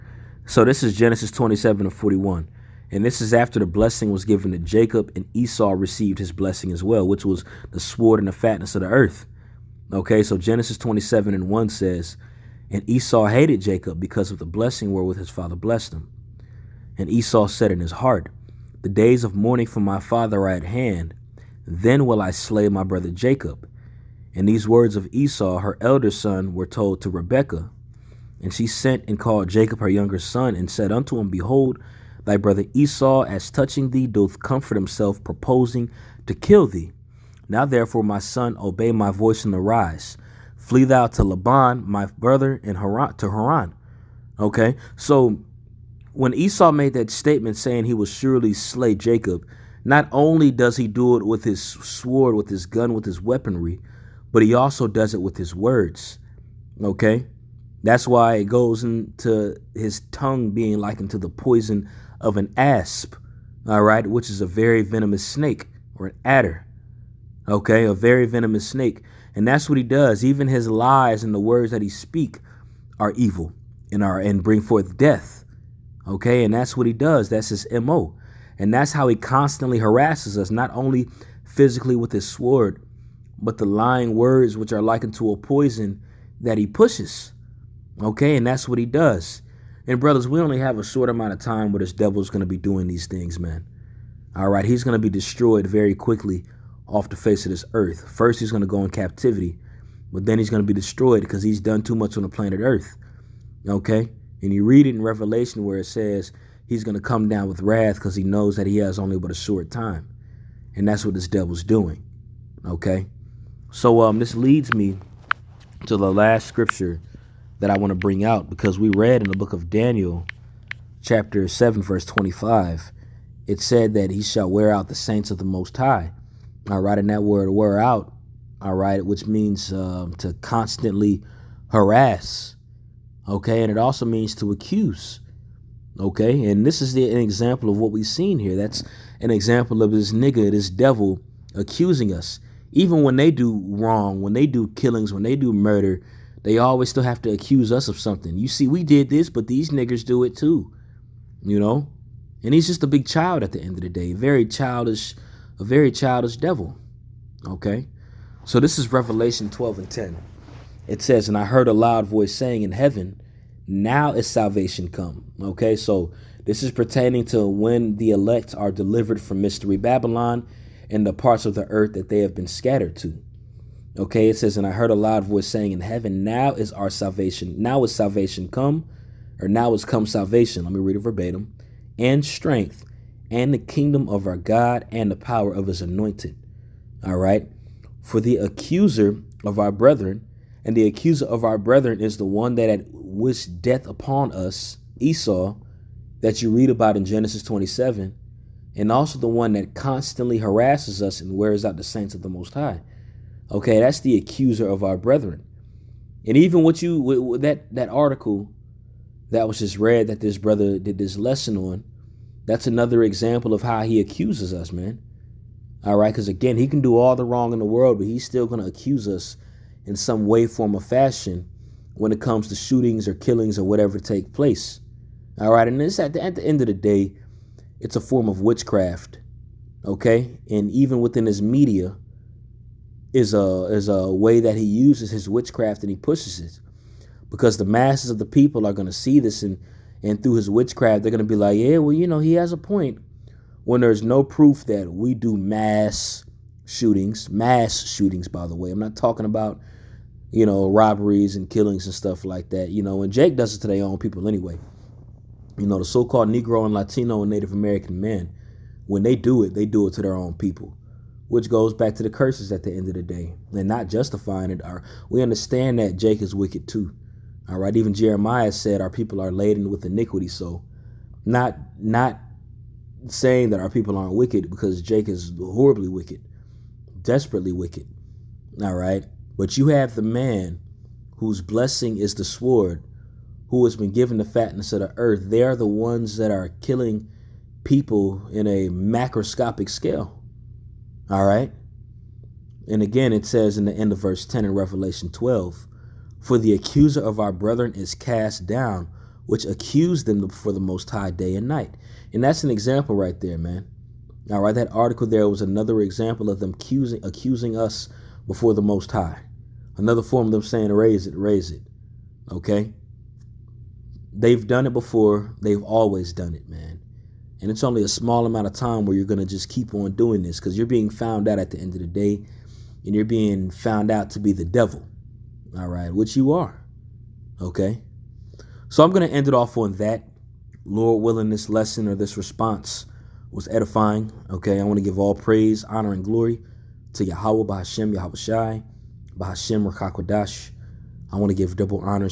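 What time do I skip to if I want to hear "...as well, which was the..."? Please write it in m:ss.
0:06.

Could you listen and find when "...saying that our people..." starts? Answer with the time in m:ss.
4:33.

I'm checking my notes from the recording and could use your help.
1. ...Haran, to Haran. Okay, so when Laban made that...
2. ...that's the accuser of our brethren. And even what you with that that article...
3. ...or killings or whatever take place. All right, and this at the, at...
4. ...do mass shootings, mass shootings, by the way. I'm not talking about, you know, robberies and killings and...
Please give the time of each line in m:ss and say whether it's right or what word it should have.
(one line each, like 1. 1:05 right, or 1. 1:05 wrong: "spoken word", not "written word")
1. 0:42 wrong: "Esau", not "Laban"
2. 3:23 right
3. 3:43 right
4. 4:05 right.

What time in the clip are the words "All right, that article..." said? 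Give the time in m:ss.
5:04.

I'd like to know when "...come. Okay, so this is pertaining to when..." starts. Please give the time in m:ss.
2:44.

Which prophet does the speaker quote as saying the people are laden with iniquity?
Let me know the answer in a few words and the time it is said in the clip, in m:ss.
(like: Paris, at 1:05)
Jeremiah, at 4:27.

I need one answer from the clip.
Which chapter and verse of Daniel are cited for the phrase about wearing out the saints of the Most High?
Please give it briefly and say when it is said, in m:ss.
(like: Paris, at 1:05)
Chapter 7, verse 25, at 2:01.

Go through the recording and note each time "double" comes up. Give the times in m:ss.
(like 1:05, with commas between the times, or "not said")
5:41.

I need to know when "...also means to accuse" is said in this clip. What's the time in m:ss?
2:13.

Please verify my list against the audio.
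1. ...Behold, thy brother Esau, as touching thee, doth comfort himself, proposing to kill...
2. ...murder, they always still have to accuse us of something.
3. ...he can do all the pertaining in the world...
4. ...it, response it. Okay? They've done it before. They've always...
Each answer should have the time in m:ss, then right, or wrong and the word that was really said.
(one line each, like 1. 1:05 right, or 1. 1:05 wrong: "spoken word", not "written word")
1. 0:31 right
2. 2:25 right
3. 3:36 wrong: "wrong", not "pertaining"
4. 5:11 wrong: "raise", not "response".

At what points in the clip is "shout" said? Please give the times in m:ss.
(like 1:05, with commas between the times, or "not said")
not said.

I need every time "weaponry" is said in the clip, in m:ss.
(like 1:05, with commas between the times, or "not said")
0:53.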